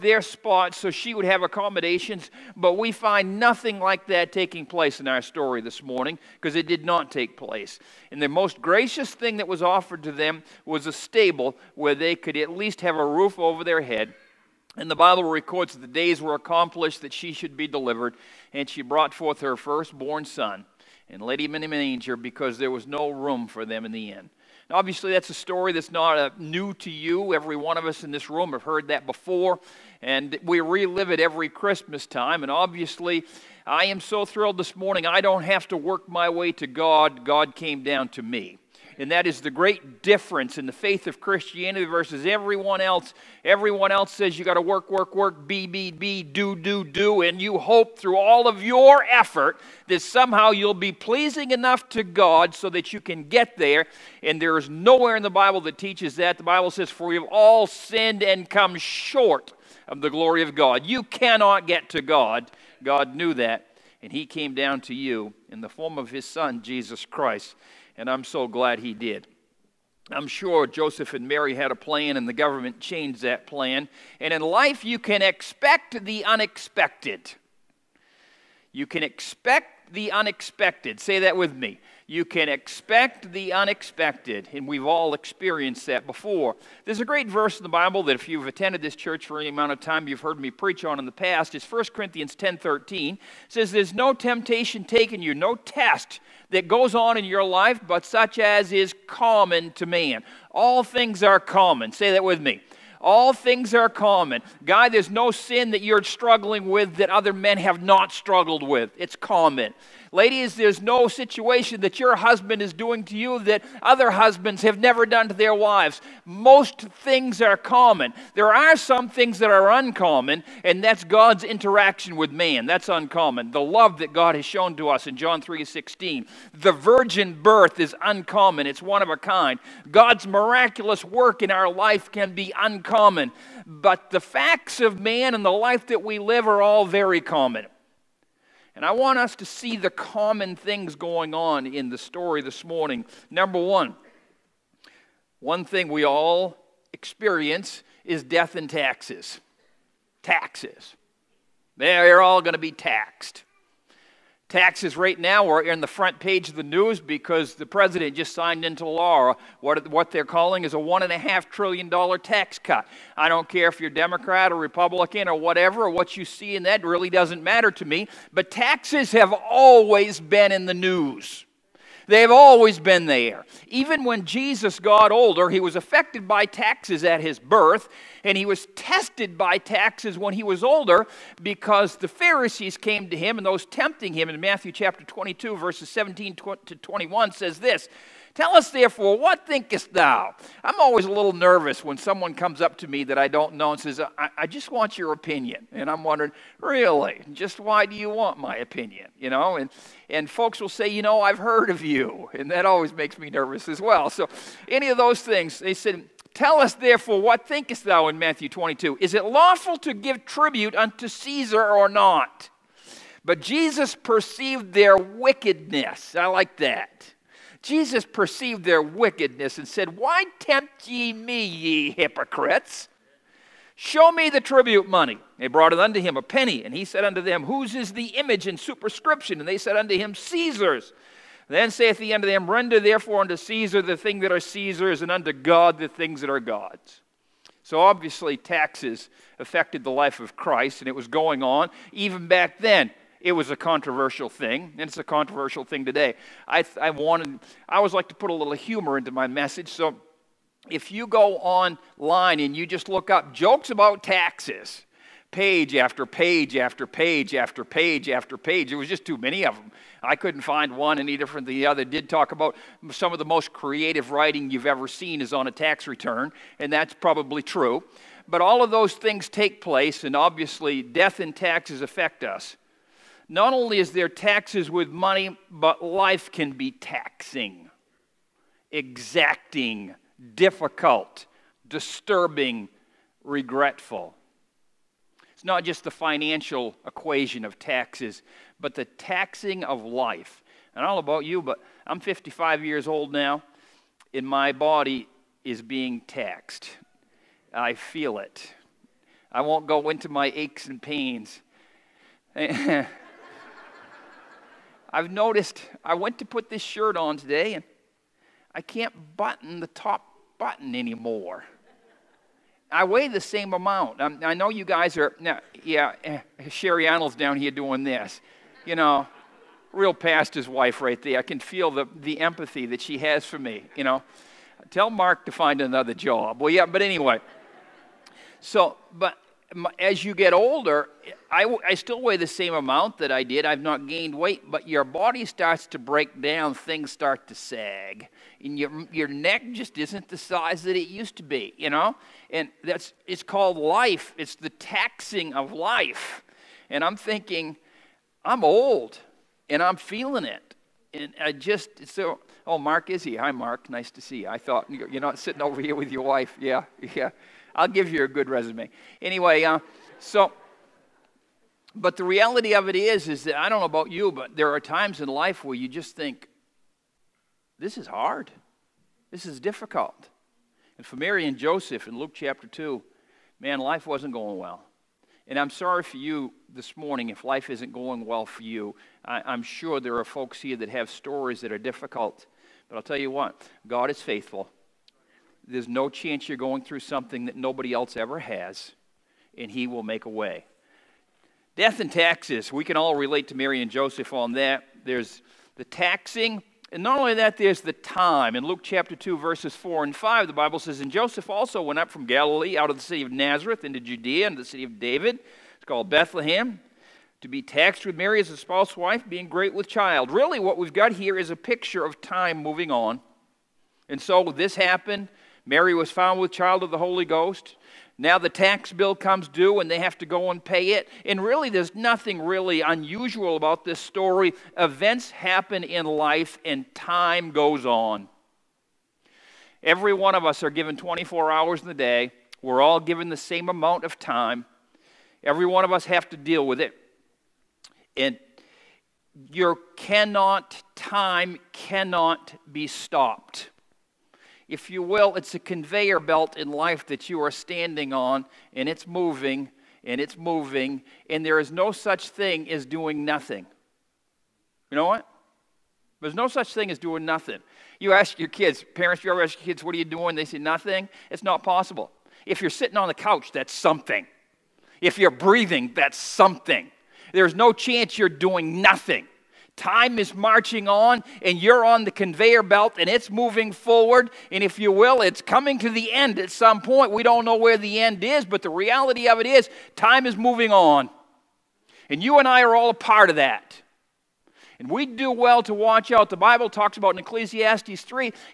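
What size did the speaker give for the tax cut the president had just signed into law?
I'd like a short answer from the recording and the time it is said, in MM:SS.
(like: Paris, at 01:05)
$1.5 trillion, at 02:40.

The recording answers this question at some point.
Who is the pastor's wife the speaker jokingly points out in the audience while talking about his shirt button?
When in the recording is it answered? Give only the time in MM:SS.
05:16.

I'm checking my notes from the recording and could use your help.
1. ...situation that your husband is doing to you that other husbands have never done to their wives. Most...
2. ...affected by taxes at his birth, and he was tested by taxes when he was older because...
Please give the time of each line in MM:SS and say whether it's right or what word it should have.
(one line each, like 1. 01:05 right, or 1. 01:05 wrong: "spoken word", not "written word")
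1. 01:51 right
2. 02:55 right.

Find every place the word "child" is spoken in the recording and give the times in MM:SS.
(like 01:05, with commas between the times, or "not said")
06:49, 06:56.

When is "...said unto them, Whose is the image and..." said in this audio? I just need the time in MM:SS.
03:46.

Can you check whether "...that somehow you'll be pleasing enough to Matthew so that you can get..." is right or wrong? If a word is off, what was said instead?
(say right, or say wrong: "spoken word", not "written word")
wrong: "God", not "Matthew".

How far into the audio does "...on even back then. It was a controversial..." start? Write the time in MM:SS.
04:01.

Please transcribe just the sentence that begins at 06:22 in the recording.
But I'll tell you what, God is faithful.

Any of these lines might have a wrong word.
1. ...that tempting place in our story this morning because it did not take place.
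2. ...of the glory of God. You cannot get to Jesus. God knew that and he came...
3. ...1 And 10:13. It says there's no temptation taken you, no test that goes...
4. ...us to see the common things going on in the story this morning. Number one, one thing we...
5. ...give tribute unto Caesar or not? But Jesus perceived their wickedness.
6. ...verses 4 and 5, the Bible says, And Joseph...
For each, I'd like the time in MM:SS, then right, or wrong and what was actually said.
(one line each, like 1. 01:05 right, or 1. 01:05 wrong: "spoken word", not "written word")
1. 00:04 wrong: "taking", not "tempting"
2. 00:59 wrong: "God", not "Jesus"
3. 01:31 wrong: "Corinthians", not "And"
4. 02:19 right
5. 03:29 right
6. 06:39 right.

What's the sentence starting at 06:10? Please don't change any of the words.
And for Mary and Joseph in Luke chapter 2, man, life wasn't going well.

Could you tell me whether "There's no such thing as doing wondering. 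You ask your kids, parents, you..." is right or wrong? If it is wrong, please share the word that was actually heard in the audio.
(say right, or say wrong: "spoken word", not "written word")
wrong: "nothing", not "wondering".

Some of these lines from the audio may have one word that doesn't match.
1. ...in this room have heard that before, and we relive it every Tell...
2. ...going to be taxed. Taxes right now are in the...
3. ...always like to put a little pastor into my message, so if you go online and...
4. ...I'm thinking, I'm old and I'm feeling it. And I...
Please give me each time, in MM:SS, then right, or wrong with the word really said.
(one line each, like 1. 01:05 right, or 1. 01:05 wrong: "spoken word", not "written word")
1. 00:28 wrong: "Christmas", not "Tell"
2. 02:32 right
3. 04:07 wrong: "humor", not "pastor"
4. 05:46 right.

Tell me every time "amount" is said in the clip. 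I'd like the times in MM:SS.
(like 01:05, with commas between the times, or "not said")
01:29, 05:13, 05:32, 07:13.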